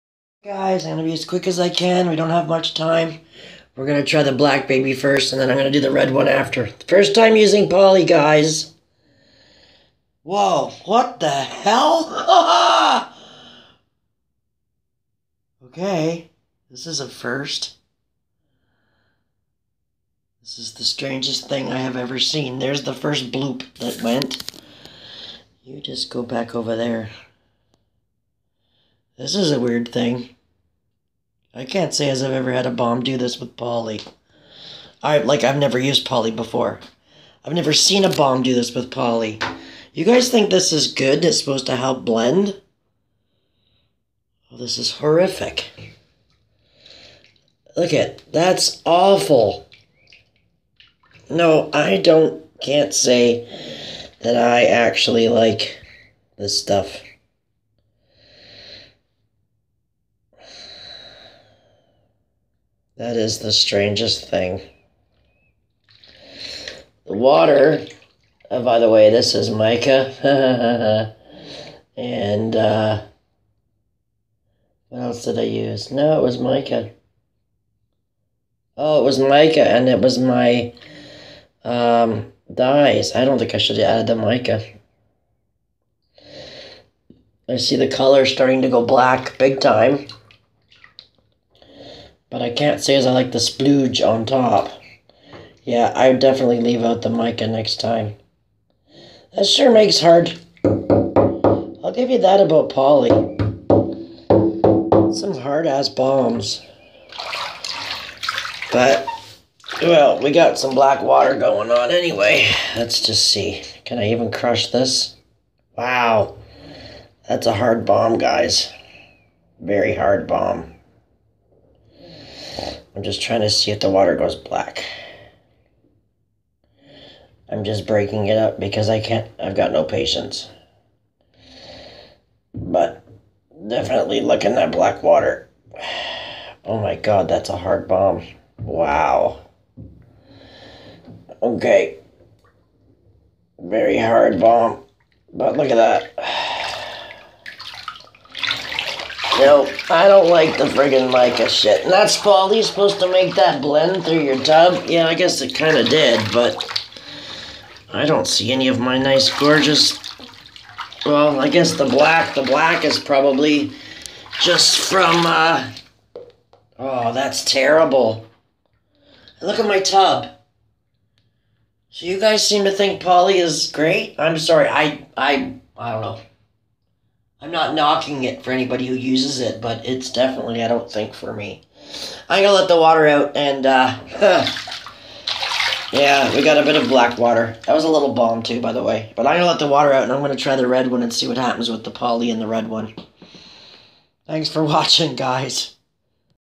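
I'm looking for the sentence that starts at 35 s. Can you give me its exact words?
I like I've never used poly before.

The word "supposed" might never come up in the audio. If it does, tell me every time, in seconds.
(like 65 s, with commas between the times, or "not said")
41 s, 152 s.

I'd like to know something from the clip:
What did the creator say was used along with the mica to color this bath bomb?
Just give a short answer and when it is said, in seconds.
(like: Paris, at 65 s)
dyes, at 82 s.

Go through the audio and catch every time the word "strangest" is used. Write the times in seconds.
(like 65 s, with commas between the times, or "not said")
20 s, 63 s.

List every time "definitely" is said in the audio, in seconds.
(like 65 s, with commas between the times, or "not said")
96 s, 133 s, 180 s.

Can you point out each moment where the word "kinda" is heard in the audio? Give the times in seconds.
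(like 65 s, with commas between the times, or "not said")
155 s.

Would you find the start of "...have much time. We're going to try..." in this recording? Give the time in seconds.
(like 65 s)
2 s.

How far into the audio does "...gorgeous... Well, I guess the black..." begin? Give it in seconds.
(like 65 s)
159 s.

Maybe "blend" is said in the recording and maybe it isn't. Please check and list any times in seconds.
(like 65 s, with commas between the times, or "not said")
42 s, 153 s.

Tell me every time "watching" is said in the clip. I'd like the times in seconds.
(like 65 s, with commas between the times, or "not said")
194 s.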